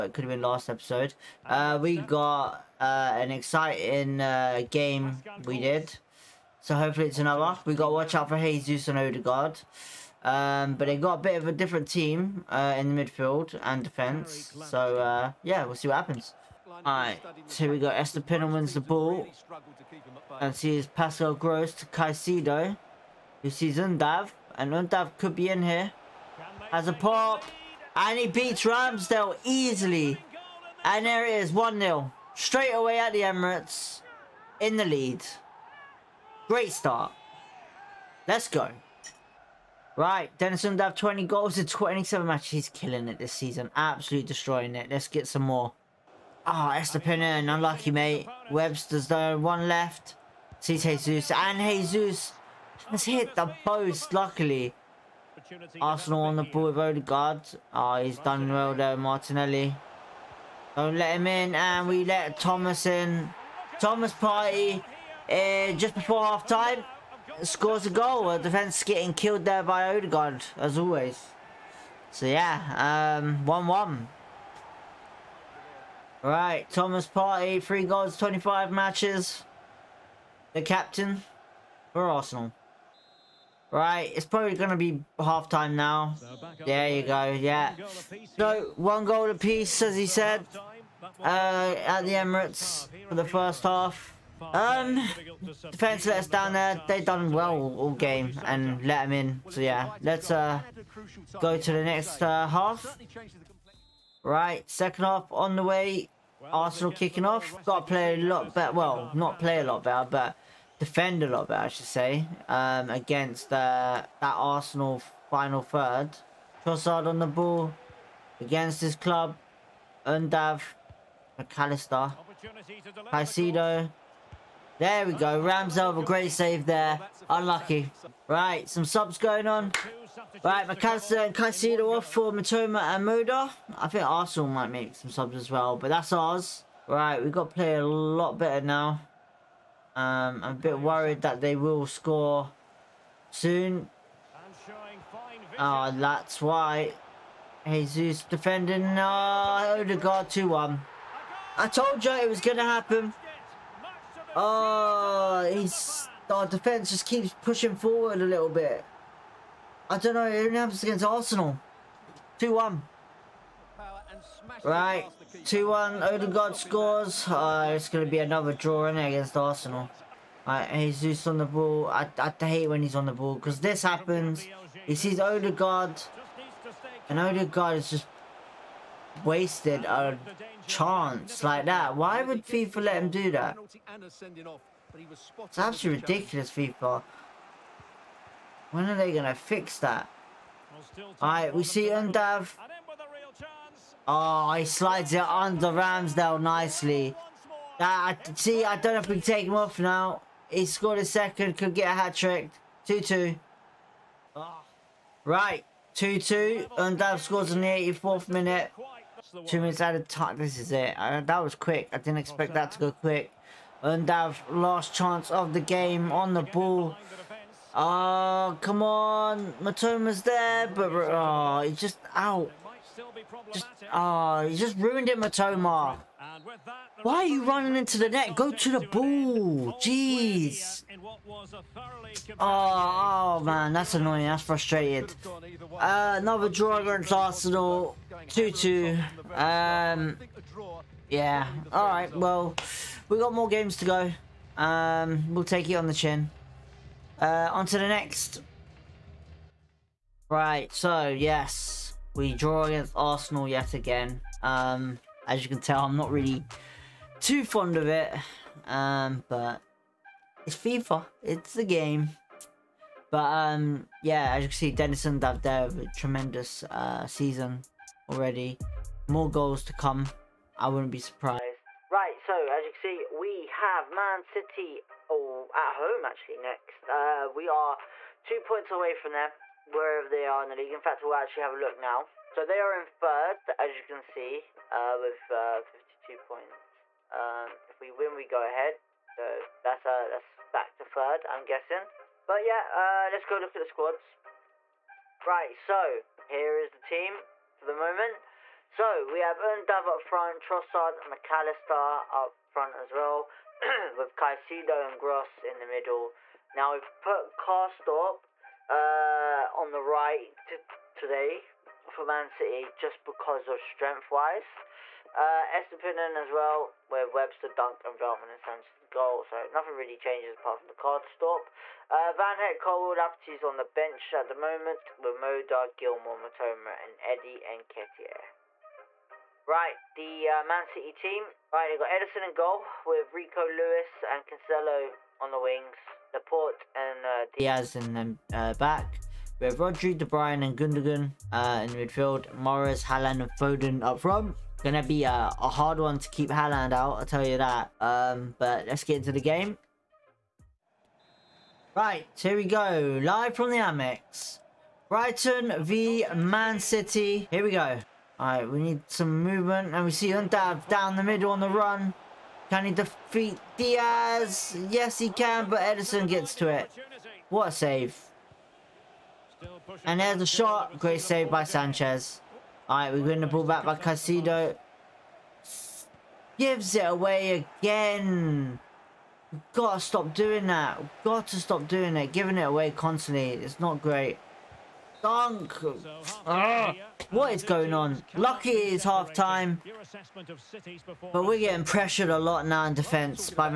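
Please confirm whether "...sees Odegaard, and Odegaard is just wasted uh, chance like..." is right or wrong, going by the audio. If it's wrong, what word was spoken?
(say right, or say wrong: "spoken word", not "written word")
right.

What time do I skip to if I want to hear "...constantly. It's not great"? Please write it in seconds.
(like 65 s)
382 s.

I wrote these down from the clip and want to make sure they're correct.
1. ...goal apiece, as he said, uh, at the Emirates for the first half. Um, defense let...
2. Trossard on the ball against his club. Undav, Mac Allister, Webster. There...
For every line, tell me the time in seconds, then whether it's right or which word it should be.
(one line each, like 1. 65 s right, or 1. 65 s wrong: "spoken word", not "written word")
1. 89 s right
2. 116 s wrong: "Caicedo", not "Webster".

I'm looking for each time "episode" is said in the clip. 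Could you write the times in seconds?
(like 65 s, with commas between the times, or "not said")
0 s.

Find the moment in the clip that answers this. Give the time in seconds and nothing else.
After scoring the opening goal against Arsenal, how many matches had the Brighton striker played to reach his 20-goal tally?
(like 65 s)
41 s.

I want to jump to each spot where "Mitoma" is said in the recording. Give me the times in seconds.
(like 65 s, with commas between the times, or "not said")
132 s, 219 s, 225 s, 326 s.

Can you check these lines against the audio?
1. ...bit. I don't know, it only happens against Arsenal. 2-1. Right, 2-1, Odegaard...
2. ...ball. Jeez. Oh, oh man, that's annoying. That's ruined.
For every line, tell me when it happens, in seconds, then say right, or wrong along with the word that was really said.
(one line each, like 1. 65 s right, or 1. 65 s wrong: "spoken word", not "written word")
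1. 158 s right
2. 228 s wrong: "frustrated", not "ruined".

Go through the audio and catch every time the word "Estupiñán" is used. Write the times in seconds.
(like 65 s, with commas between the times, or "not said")
17 s, 46 s, 315 s.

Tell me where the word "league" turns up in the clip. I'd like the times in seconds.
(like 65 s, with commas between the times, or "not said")
280 s.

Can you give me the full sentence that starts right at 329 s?
Right, the uh, Man City team.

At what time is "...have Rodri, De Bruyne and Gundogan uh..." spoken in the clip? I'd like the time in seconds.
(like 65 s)
339 s.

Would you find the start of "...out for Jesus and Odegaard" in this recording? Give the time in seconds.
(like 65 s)
8 s.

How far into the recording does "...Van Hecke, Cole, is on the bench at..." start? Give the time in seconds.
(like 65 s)
322 s.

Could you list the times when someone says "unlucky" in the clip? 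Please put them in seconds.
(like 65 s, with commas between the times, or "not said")
47 s, 127 s.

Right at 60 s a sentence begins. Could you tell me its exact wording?
Don't let him in, and we let Thomas in.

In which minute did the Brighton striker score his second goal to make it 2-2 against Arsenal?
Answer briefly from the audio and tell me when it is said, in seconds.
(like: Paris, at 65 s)
84th, at 207 s.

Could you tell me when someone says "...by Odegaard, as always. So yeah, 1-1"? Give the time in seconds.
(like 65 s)
69 s.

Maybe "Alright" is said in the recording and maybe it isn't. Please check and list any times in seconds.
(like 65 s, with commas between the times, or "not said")
16 s, 191 s, 358 s, 372 s.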